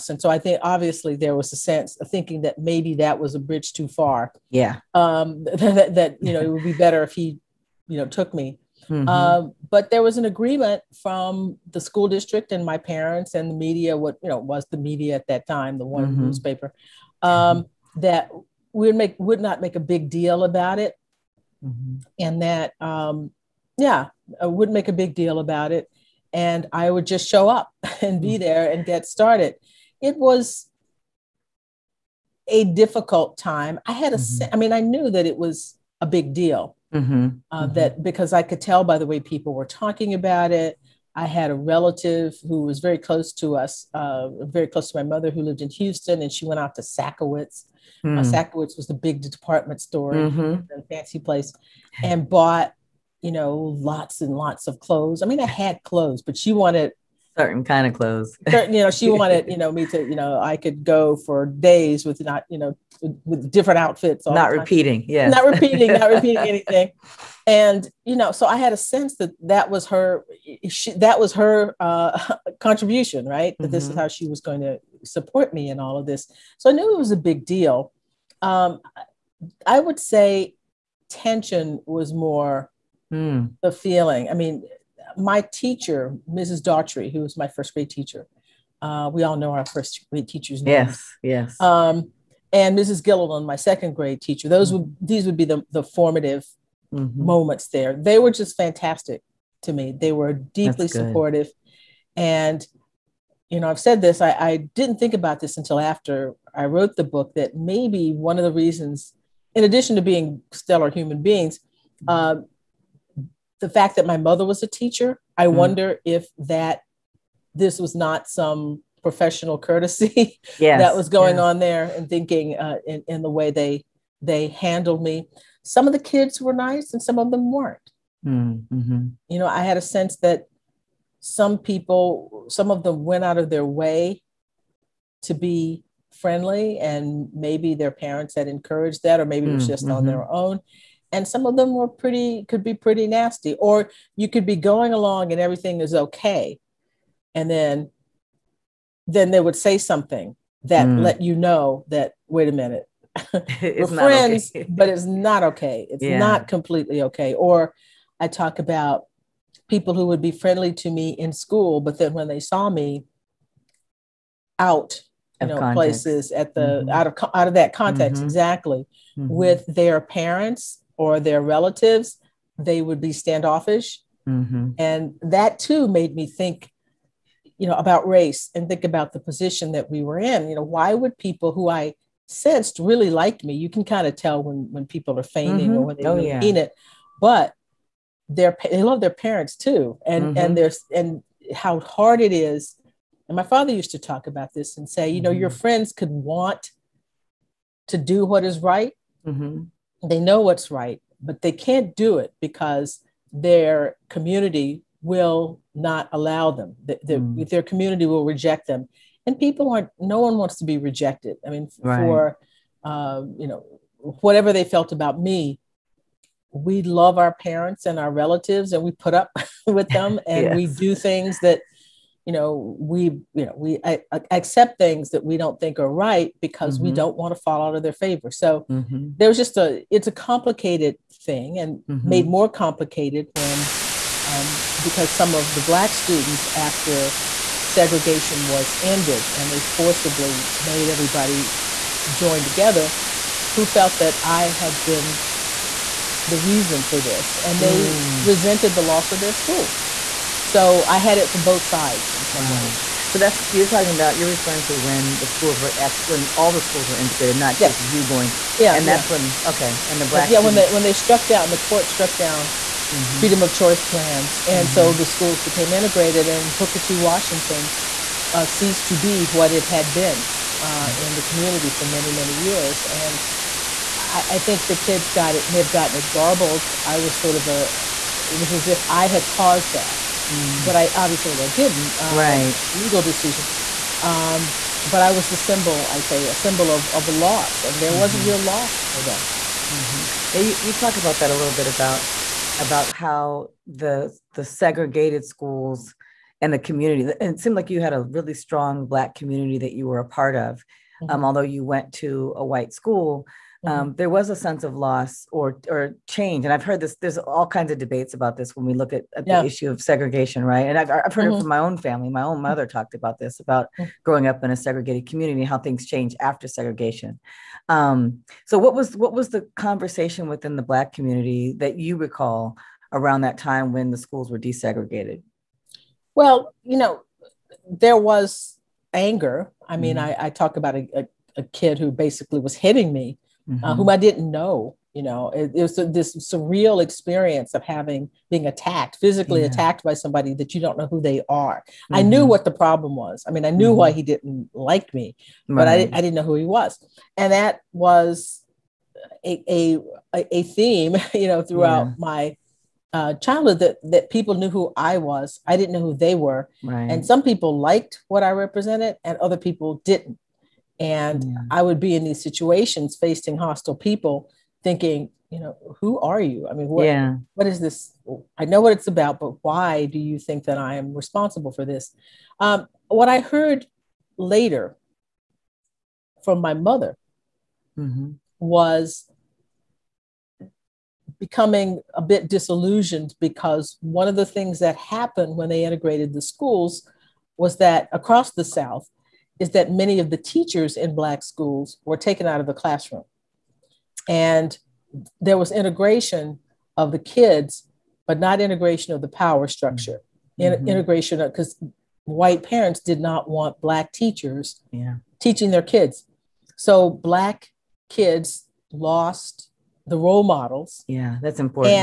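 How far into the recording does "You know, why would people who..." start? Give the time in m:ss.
3:00.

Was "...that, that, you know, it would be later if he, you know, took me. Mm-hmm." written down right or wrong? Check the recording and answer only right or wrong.
wrong.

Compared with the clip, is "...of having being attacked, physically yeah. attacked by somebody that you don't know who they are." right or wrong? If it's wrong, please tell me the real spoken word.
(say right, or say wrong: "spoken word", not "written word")
right.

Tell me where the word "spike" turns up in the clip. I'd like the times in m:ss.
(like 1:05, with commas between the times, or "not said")
not said.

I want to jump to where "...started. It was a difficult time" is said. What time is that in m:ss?
0:29.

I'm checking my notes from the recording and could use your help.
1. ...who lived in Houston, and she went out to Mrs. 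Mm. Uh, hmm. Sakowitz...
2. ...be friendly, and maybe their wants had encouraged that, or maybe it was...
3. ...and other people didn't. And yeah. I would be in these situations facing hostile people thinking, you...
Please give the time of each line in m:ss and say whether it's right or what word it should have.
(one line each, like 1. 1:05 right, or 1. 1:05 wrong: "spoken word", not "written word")
1. 0:45 wrong: "Sakowitz", not "Mrs"
2. 2:15 wrong: "parents", not "wants"
3. 5:59 right.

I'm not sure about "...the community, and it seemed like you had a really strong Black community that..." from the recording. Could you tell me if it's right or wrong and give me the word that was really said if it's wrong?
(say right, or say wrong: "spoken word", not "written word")
right.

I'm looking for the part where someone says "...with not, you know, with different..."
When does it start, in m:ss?
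1:02.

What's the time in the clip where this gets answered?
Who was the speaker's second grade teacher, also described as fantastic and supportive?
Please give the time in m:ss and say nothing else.
1:32.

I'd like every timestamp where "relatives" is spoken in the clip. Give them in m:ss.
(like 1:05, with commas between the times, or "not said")
0:41, 2:51, 3:38.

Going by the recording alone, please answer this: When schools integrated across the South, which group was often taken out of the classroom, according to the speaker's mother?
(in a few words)
teachers in Black schools.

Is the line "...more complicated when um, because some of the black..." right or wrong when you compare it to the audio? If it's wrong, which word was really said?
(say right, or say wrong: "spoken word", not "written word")
right.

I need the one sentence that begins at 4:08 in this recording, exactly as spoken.
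resented the loss of their school so I had it for both sides in some wow.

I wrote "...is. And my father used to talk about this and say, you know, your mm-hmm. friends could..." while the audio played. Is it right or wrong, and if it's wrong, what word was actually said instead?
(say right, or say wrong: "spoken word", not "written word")
right.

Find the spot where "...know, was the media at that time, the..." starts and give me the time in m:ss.
0:14.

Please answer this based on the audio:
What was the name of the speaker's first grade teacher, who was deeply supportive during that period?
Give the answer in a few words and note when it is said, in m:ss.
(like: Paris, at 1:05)
Mrs. Daughtry, at 1:26.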